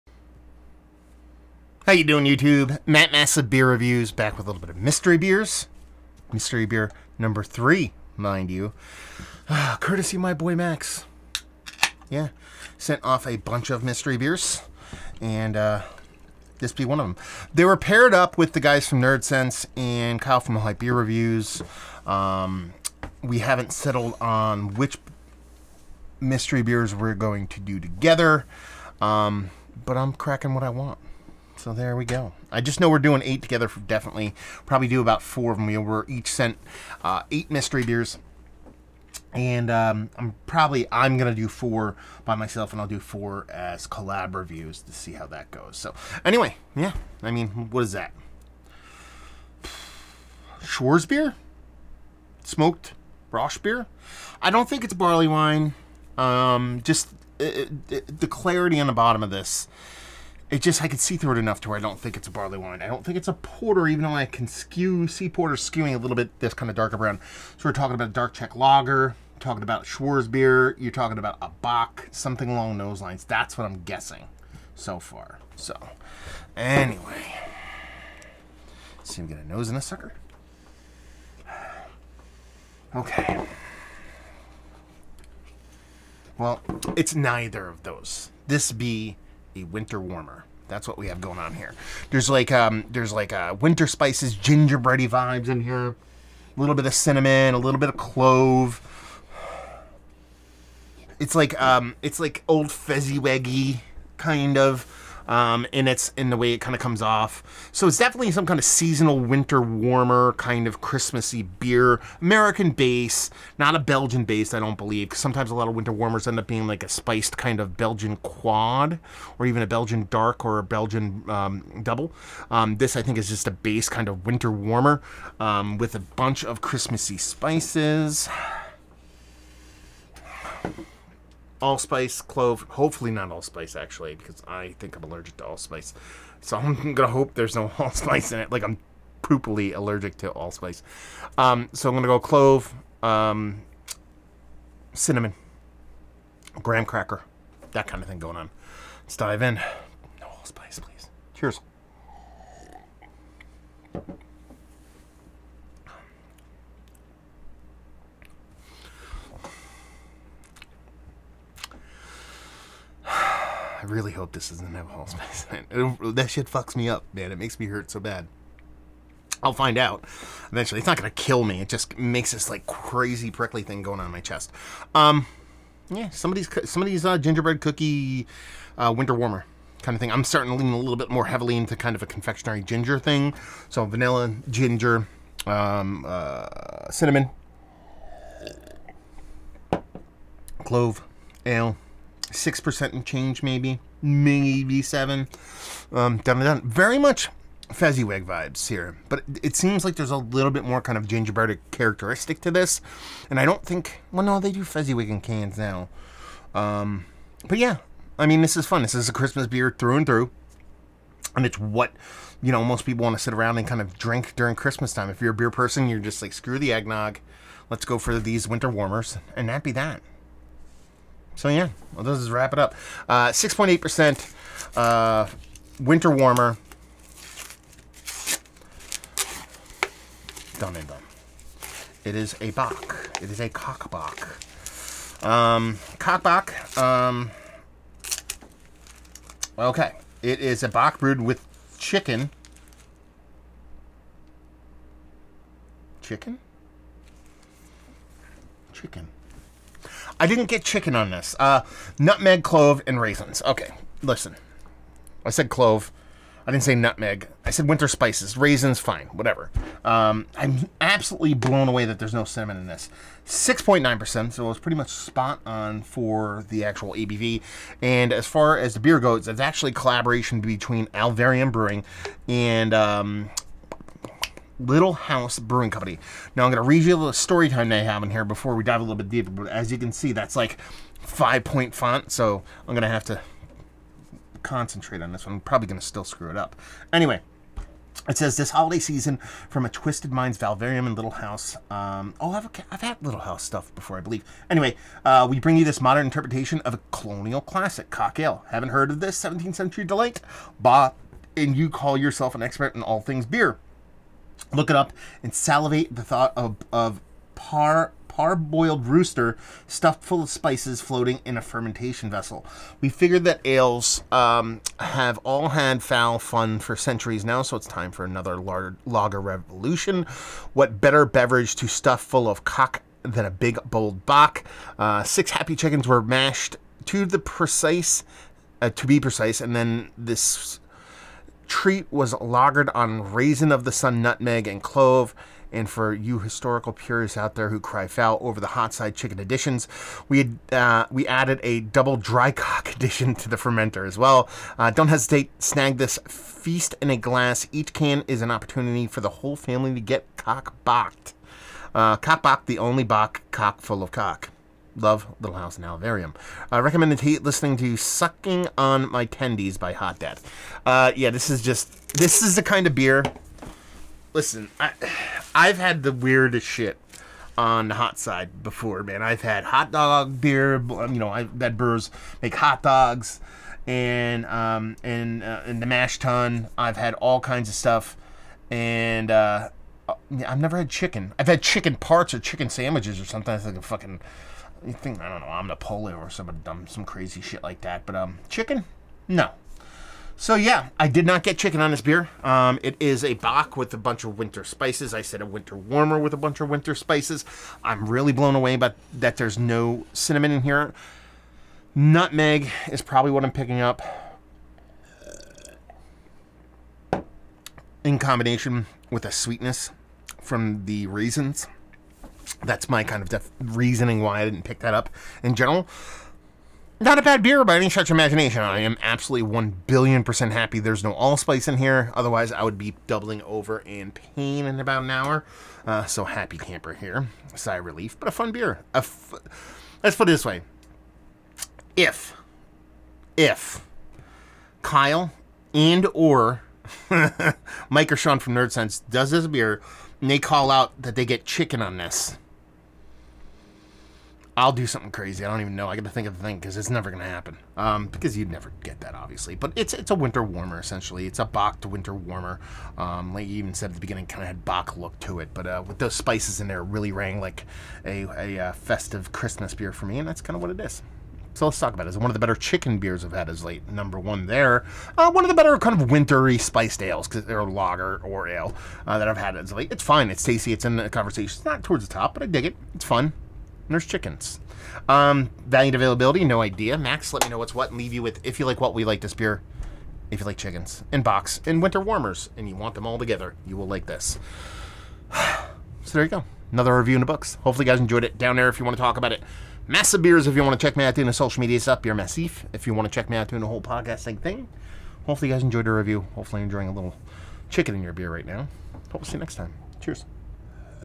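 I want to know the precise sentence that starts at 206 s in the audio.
Um, but yeah, I mean, this is fun.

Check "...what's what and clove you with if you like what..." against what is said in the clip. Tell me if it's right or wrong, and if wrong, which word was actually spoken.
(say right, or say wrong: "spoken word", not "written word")
wrong: "leave", not "clove".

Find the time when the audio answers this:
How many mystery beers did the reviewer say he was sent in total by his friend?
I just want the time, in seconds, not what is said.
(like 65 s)
37 s.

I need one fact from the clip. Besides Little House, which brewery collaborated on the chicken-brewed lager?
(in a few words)
Alvarium Brewing.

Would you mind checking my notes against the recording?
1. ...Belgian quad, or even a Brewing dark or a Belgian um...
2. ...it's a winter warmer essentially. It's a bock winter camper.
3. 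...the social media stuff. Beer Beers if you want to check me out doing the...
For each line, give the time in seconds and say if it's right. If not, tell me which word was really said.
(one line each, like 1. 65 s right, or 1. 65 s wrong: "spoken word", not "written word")
1. 117 s wrong: "Belgian", not "Brewing"
2. 449 s wrong: "warmer", not "camper"
3. 491 s wrong: "Massif", not "Beers".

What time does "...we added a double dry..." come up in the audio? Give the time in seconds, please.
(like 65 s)
340 s.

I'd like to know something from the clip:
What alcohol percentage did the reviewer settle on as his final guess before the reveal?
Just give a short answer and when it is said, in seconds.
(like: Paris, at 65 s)
6.8%, at 223 s.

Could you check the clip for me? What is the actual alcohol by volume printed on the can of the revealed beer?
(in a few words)
6.9%.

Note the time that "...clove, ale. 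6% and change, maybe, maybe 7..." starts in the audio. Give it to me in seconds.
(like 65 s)
190 s.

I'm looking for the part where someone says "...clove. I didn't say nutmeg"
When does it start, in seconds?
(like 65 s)
255 s.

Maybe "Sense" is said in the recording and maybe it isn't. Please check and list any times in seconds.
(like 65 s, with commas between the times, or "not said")
19 s, 438 s.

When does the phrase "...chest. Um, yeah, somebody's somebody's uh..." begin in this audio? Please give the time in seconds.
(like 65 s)
174 s.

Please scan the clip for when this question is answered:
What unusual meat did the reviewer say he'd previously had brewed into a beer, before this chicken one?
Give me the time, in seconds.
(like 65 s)
369 s.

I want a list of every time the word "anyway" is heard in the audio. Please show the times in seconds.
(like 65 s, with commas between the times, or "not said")
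46 s, 76 s, 286 s, 294 s.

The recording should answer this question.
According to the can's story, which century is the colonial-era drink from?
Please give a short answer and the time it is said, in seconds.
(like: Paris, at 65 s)
17th century, at 299 s.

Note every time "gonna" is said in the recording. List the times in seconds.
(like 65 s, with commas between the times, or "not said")
136 s, 141 s.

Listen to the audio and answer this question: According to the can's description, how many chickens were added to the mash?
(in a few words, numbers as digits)
6.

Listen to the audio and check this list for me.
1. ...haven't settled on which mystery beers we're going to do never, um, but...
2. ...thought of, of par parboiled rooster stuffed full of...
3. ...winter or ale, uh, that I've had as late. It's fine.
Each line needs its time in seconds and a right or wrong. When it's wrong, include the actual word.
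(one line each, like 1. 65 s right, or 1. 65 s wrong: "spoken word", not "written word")
1. 23 s wrong: "together", not "never"
2. 306 s right
3. 467 s wrong: "lager", not "winter".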